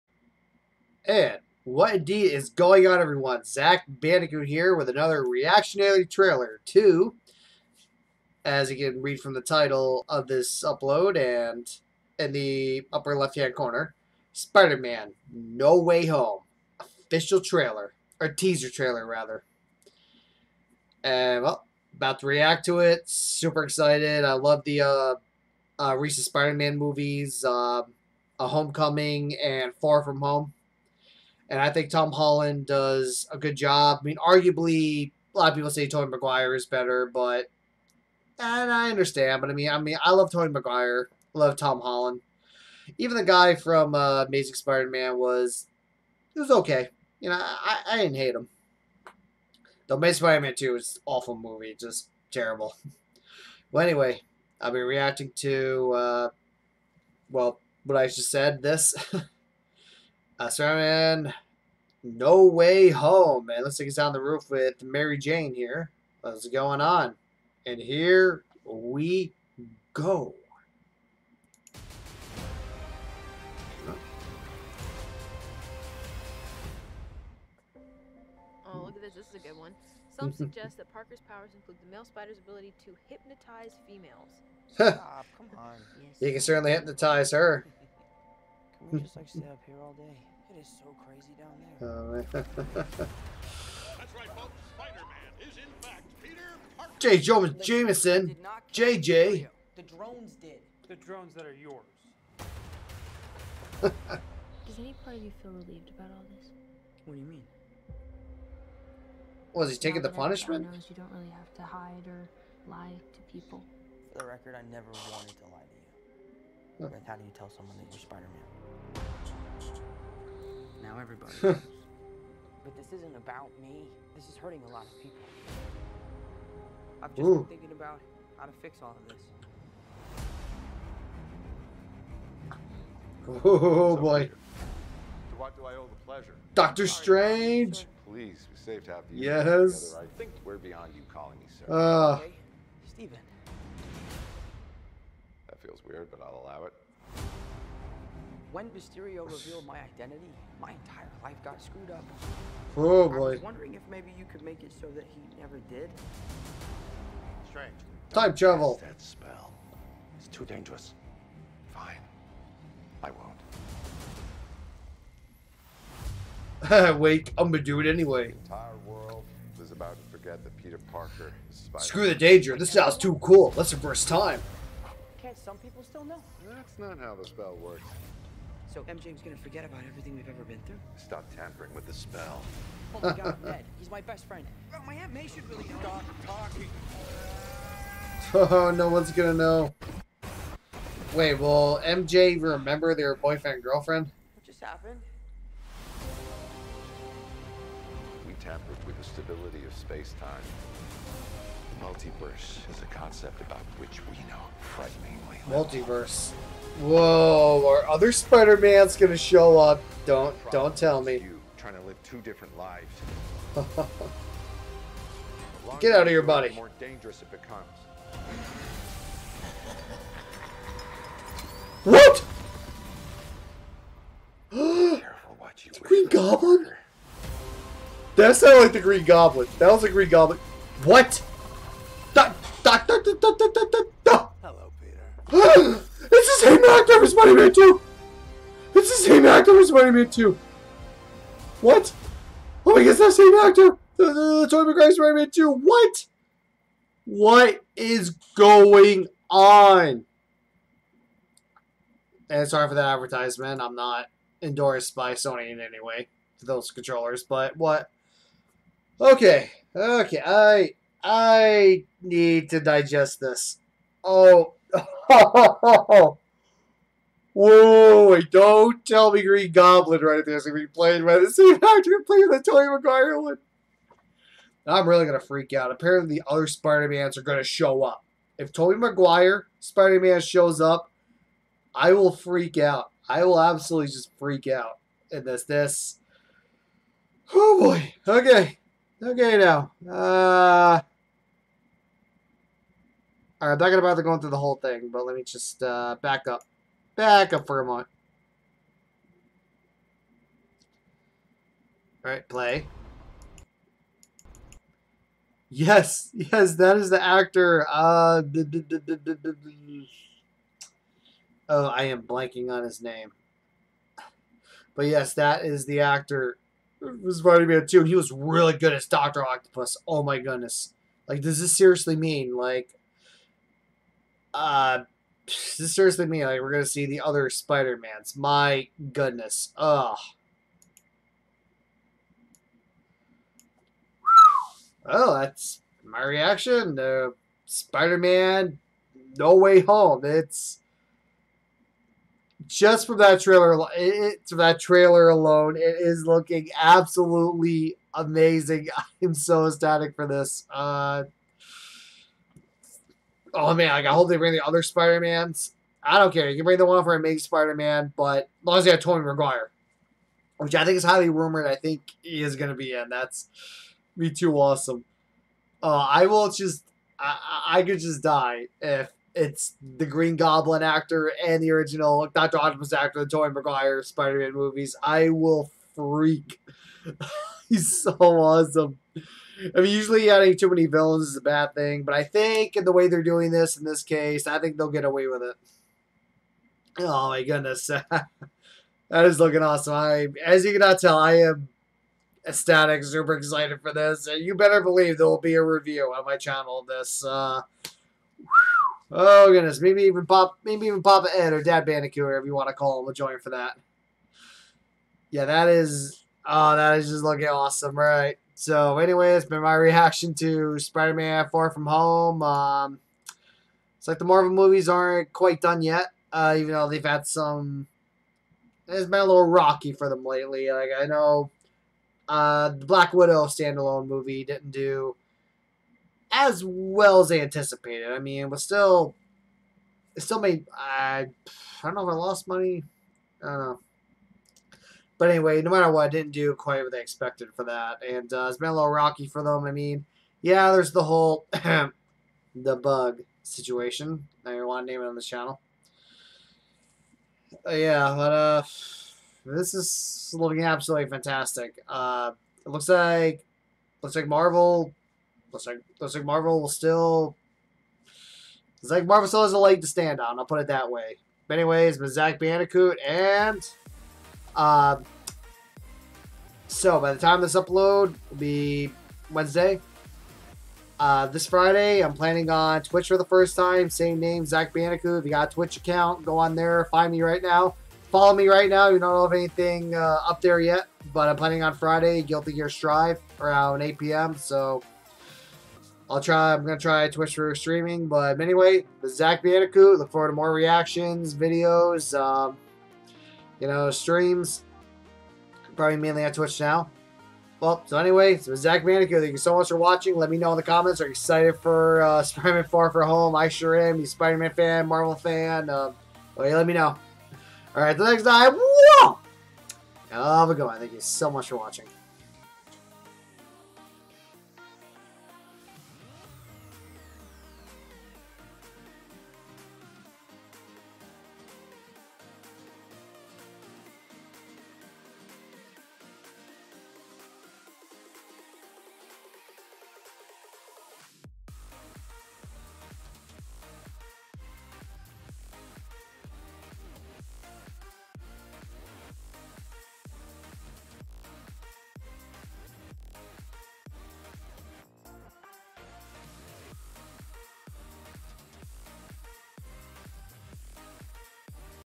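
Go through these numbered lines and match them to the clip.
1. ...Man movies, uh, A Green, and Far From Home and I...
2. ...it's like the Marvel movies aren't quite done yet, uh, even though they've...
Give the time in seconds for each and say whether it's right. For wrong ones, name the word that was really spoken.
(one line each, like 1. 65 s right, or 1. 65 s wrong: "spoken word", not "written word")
1. 26 s wrong: "Homecoming", not "Green"
2. 413 s right.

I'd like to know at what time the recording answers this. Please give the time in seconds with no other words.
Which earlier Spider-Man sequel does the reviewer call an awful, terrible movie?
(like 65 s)
49 s.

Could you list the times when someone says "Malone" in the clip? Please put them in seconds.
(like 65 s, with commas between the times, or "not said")
not said.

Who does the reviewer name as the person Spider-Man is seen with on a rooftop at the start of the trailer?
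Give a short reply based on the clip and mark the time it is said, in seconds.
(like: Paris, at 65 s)
Mary Jane, at 64 s.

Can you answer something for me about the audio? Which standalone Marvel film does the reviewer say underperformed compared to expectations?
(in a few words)
Black Widow.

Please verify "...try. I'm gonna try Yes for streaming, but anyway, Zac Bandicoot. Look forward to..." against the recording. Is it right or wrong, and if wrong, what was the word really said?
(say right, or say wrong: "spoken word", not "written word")
wrong: "Twitch", not "Yes".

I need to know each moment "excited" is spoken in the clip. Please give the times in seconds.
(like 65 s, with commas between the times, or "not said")
23 s, 393 s, 500 s.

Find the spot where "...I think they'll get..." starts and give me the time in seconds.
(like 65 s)
384 s.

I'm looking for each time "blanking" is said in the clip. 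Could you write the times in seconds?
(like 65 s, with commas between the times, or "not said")
312 s.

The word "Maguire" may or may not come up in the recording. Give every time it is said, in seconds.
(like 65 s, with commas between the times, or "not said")
36 s, 40 s, 244 s, 272 s, 278 s, 359 s, 373 s.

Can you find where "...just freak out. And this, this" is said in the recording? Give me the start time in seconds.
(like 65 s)
283 s.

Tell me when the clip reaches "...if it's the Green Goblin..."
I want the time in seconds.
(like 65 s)
368 s.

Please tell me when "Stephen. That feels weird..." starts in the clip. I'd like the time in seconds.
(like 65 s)
142 s.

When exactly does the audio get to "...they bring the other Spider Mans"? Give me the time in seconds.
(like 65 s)
354 s.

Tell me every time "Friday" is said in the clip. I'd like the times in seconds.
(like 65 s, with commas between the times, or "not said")
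471 s, 481 s.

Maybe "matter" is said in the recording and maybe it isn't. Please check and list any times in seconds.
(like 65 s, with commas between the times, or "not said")
435 s.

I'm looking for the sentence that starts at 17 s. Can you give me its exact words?
Official trailer, or teaser trailer, rather.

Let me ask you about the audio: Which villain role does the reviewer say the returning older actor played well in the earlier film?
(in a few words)
Dr. Octopus.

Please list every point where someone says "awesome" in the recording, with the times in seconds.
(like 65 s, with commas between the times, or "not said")
364 s, 377 s, 389 s, 407 s.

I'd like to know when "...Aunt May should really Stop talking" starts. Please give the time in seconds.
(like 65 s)
184 s.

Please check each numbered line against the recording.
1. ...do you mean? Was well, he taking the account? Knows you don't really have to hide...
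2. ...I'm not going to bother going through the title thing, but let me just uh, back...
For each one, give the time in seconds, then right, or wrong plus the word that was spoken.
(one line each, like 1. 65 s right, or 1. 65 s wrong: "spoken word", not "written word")
1. 107 s wrong: "punishment", not "account"
2. 293 s wrong: "whole", not "title".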